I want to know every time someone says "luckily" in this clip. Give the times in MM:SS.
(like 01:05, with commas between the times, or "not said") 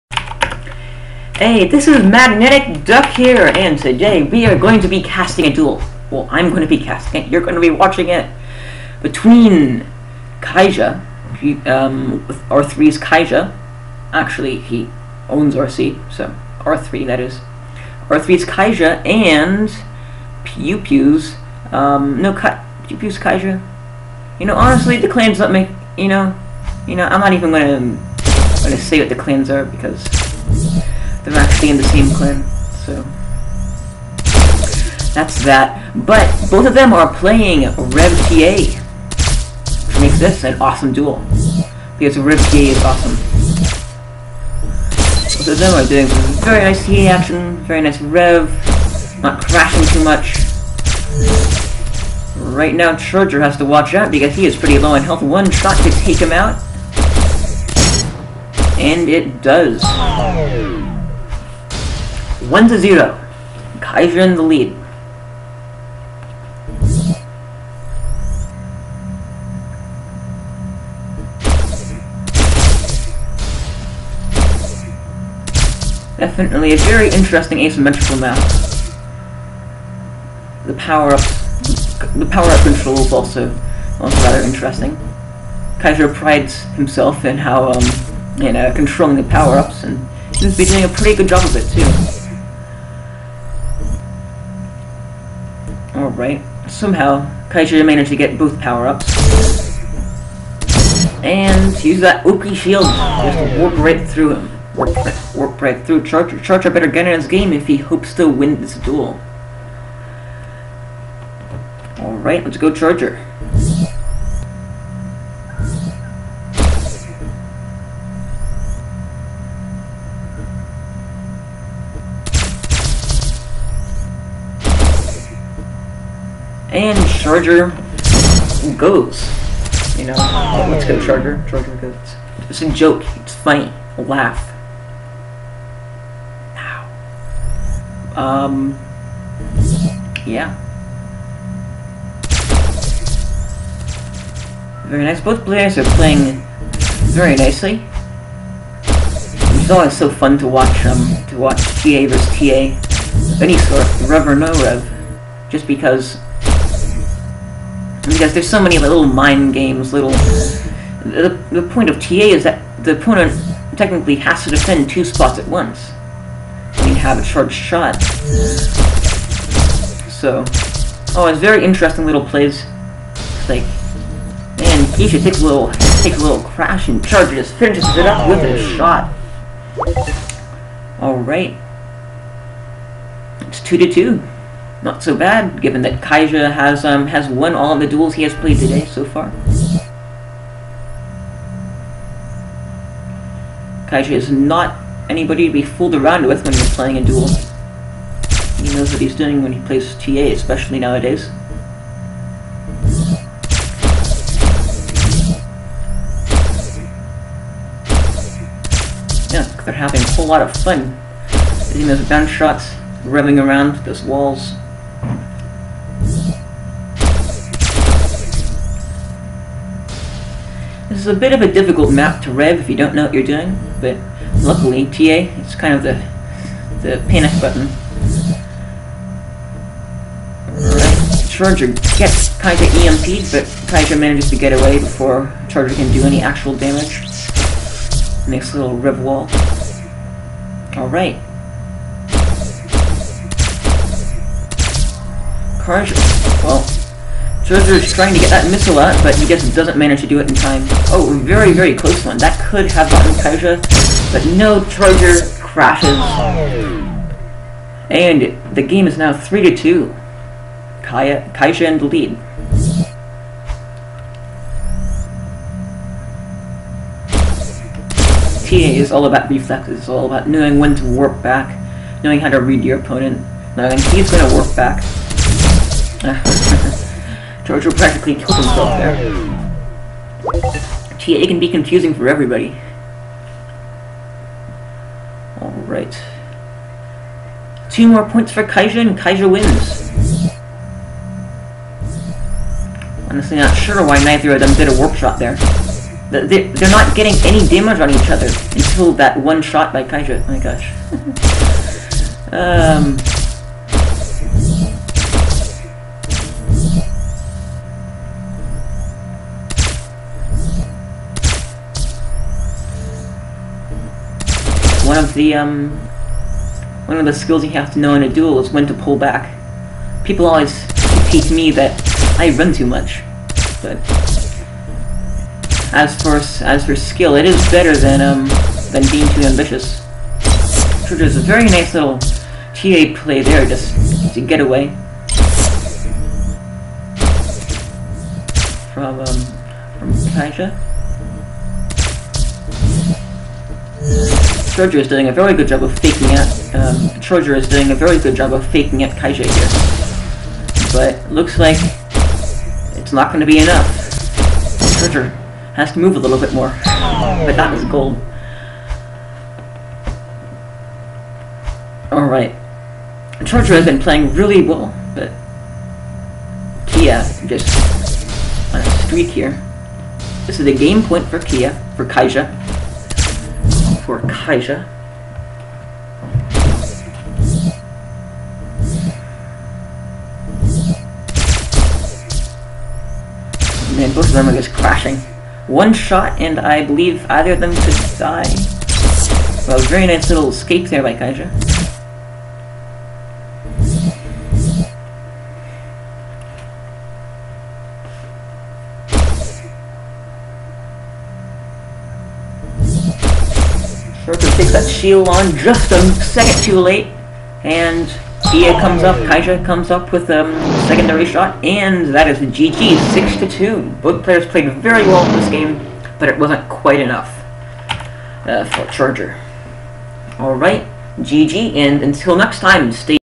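03:44.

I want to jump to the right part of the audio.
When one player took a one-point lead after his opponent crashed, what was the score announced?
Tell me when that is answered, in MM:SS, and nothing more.
04:19.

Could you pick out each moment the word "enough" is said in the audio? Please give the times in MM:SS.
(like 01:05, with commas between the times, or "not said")
05:53, 06:56.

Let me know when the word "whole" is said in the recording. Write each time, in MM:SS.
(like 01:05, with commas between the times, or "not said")
03:30.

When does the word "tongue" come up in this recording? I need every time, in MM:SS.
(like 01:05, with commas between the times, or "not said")
not said.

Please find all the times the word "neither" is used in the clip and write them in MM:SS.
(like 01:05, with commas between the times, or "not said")
04:54.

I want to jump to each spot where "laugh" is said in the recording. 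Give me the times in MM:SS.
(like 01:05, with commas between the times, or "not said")
02:13.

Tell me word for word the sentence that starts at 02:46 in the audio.
You mean, have a charged shot.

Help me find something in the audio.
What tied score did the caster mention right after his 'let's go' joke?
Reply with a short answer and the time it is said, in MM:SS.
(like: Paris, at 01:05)
2 to 2, at 03:03.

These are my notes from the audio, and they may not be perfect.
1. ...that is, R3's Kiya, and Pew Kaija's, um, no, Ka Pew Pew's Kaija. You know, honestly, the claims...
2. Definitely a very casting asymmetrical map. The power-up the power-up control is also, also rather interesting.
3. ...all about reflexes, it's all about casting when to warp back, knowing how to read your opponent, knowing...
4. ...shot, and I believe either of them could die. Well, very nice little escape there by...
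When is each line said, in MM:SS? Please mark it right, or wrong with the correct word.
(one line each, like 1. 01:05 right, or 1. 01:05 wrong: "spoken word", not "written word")
1. 00:17 wrong: "Pew", not "Kaija"
2. 01:16 wrong: "interesting", not "casting"
3. 04:28 wrong: "knowing", not "casting"
4. 06:25 right.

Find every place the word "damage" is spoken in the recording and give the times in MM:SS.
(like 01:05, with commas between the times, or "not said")
03:56, 04:57.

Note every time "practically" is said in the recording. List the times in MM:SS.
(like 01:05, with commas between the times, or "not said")
04:37.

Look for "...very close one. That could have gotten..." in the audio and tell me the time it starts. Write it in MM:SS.
04:11.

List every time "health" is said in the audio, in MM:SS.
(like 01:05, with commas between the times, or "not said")
00:55.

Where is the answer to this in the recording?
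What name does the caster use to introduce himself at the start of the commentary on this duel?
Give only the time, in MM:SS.
00:02.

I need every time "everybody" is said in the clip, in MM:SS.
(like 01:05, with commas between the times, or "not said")
04:42.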